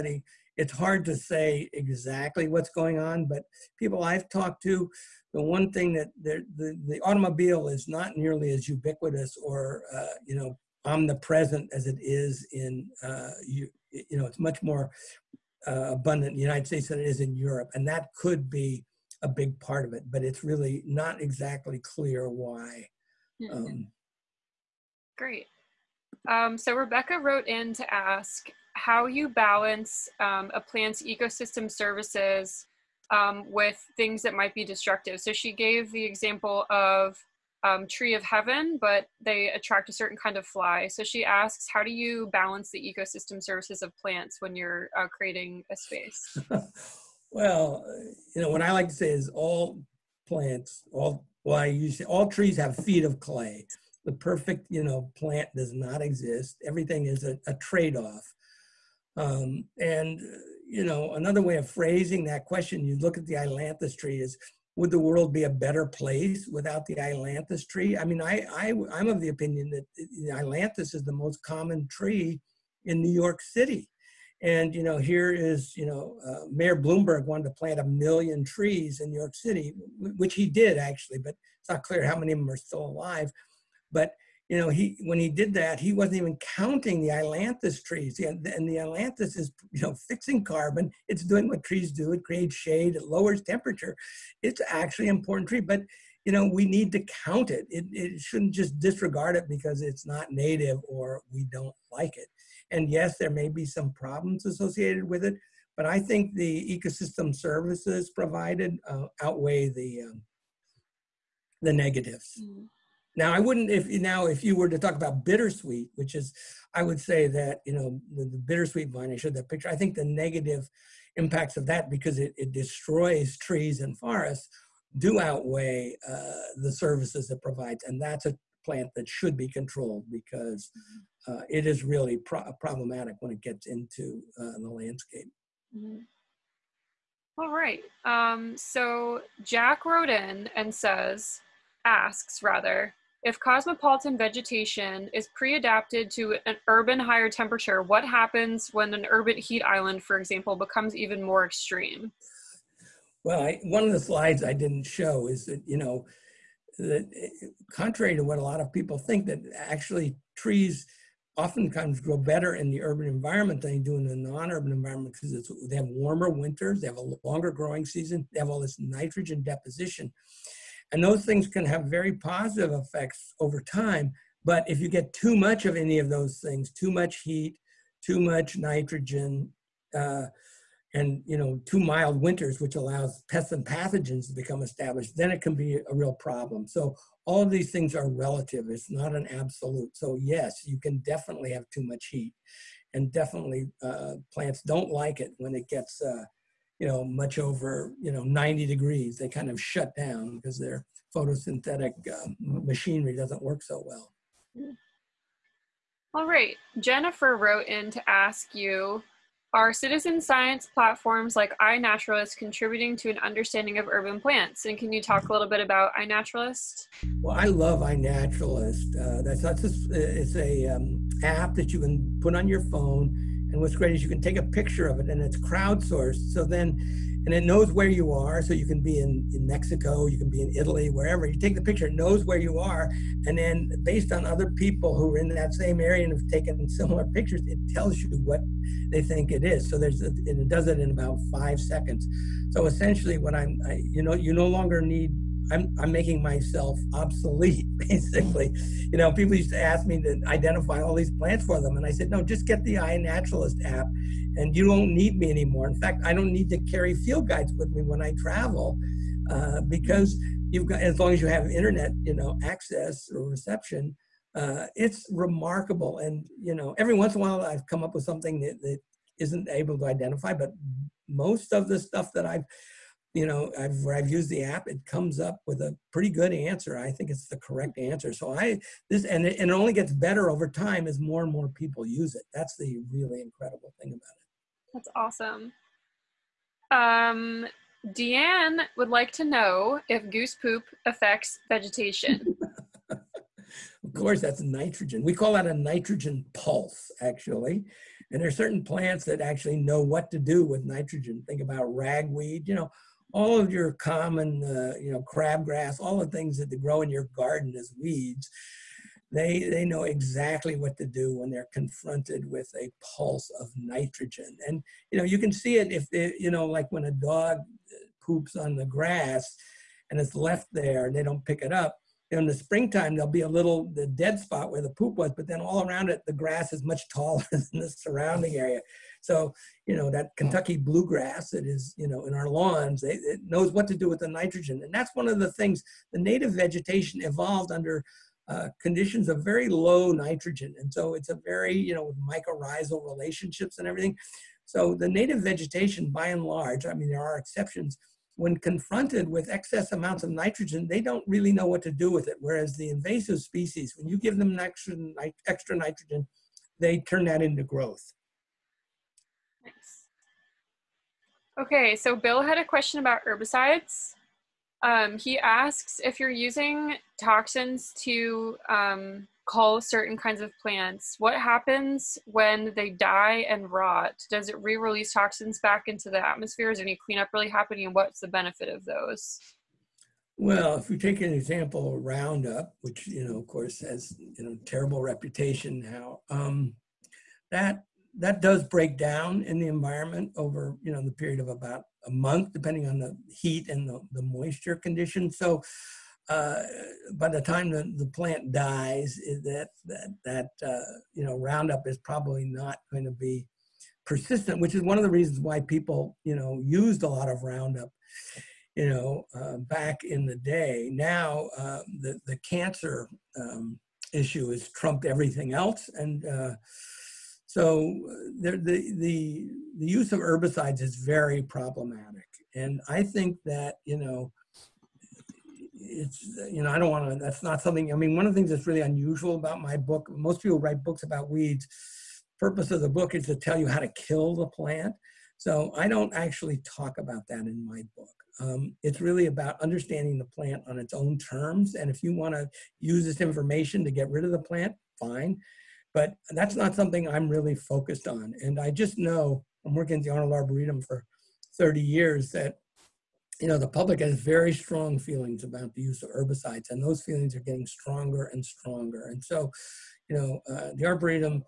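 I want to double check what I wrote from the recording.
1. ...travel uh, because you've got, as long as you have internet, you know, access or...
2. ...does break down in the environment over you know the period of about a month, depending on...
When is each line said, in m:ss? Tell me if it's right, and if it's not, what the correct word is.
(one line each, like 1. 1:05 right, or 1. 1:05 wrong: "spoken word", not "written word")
1. 4:18 right
2. 6:28 right.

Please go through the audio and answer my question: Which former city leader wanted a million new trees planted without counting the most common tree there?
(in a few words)
Mayor Bloomberg.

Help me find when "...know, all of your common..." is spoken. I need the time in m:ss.
5:02.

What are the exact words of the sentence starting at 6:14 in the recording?
Does it re-release toxins back into the atmosphere?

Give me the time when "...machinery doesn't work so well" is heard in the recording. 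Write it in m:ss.
3:22.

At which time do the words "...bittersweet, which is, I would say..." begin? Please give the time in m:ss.
1:55.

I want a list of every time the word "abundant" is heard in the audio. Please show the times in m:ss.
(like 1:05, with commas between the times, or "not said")
0:15.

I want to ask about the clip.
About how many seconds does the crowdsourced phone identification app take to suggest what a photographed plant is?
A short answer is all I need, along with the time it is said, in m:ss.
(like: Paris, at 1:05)
5, at 4:01.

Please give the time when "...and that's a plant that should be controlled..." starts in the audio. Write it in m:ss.
2:07.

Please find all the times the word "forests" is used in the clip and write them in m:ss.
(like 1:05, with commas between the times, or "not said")
2:03.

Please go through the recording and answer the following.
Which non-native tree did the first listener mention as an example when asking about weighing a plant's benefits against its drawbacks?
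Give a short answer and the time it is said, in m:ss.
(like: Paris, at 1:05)
Tree of heaven, at 0:37.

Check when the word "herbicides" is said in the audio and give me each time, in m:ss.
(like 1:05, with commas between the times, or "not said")
6:03, 6:59, 7:35.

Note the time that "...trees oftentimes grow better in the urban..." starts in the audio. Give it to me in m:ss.
2:40.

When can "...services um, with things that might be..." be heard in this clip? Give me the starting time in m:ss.
0:31.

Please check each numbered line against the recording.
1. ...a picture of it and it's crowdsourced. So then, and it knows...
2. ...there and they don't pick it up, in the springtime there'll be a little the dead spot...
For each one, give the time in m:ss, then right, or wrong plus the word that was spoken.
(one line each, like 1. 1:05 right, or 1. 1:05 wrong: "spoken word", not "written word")
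1. 3:44 right
2. 5:20 right.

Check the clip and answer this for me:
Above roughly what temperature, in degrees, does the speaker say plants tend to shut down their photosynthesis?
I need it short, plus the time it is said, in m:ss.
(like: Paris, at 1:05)
90, at 3:18.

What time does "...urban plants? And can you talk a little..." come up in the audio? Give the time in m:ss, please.
3:33.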